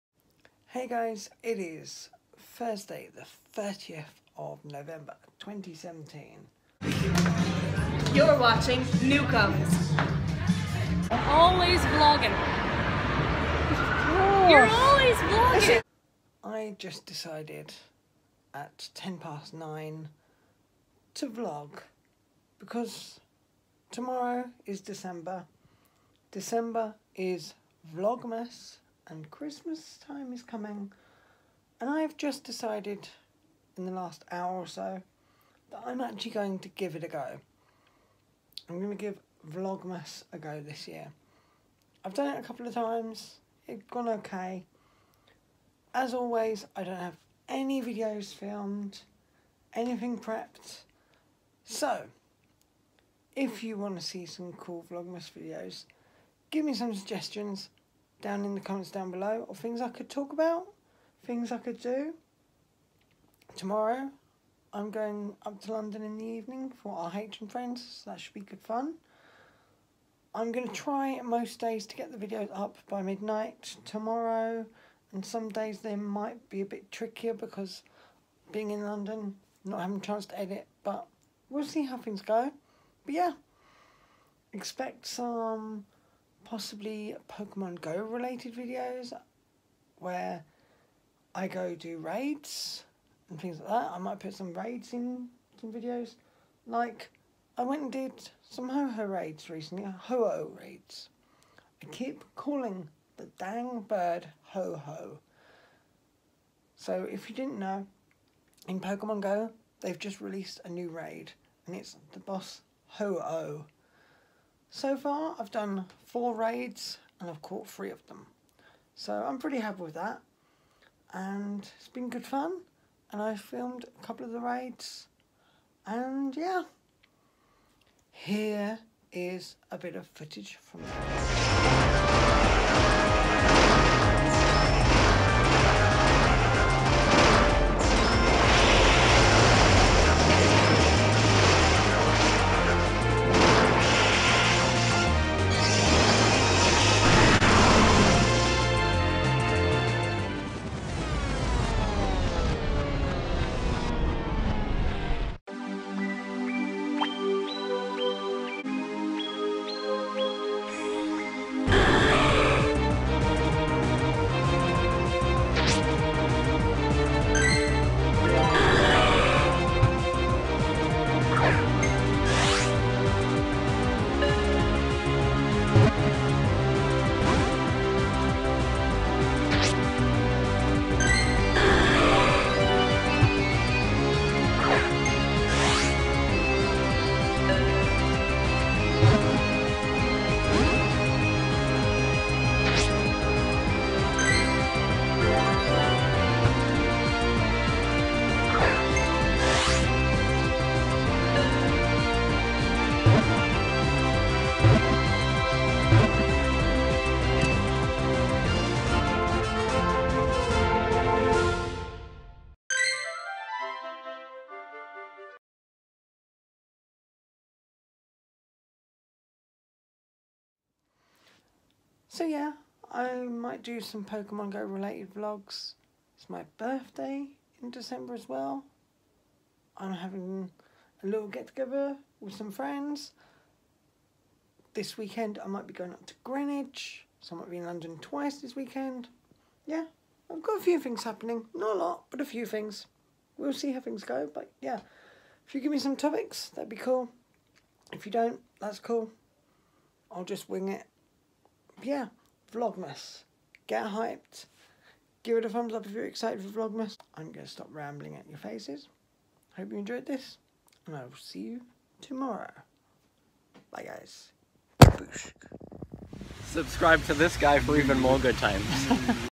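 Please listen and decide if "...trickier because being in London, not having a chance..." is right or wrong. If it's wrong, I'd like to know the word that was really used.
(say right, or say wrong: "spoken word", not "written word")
right.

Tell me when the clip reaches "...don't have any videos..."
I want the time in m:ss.
0:46.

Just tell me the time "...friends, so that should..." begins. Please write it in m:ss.
1:07.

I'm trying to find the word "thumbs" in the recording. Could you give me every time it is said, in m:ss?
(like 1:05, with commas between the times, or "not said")
4:15.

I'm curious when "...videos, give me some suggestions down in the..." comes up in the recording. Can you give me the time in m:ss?
0:55.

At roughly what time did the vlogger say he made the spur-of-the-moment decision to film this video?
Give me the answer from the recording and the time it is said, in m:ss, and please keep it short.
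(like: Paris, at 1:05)
10 past 9, at 0:18.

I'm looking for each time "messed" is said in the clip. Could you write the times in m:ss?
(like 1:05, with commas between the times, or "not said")
not said.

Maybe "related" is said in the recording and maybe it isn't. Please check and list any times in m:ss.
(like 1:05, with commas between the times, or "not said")
1:27, 3:44.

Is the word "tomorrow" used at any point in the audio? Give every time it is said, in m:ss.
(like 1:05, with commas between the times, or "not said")
0:23, 1:03, 1:13, 4:21.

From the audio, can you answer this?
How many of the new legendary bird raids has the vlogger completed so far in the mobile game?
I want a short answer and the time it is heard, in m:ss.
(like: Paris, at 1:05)
4, at 1:56.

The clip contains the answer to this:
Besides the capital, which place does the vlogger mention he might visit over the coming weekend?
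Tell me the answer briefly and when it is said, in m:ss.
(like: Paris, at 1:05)
Greenwich, at 3:56.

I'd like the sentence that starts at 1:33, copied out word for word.
I might put some raids in some videos.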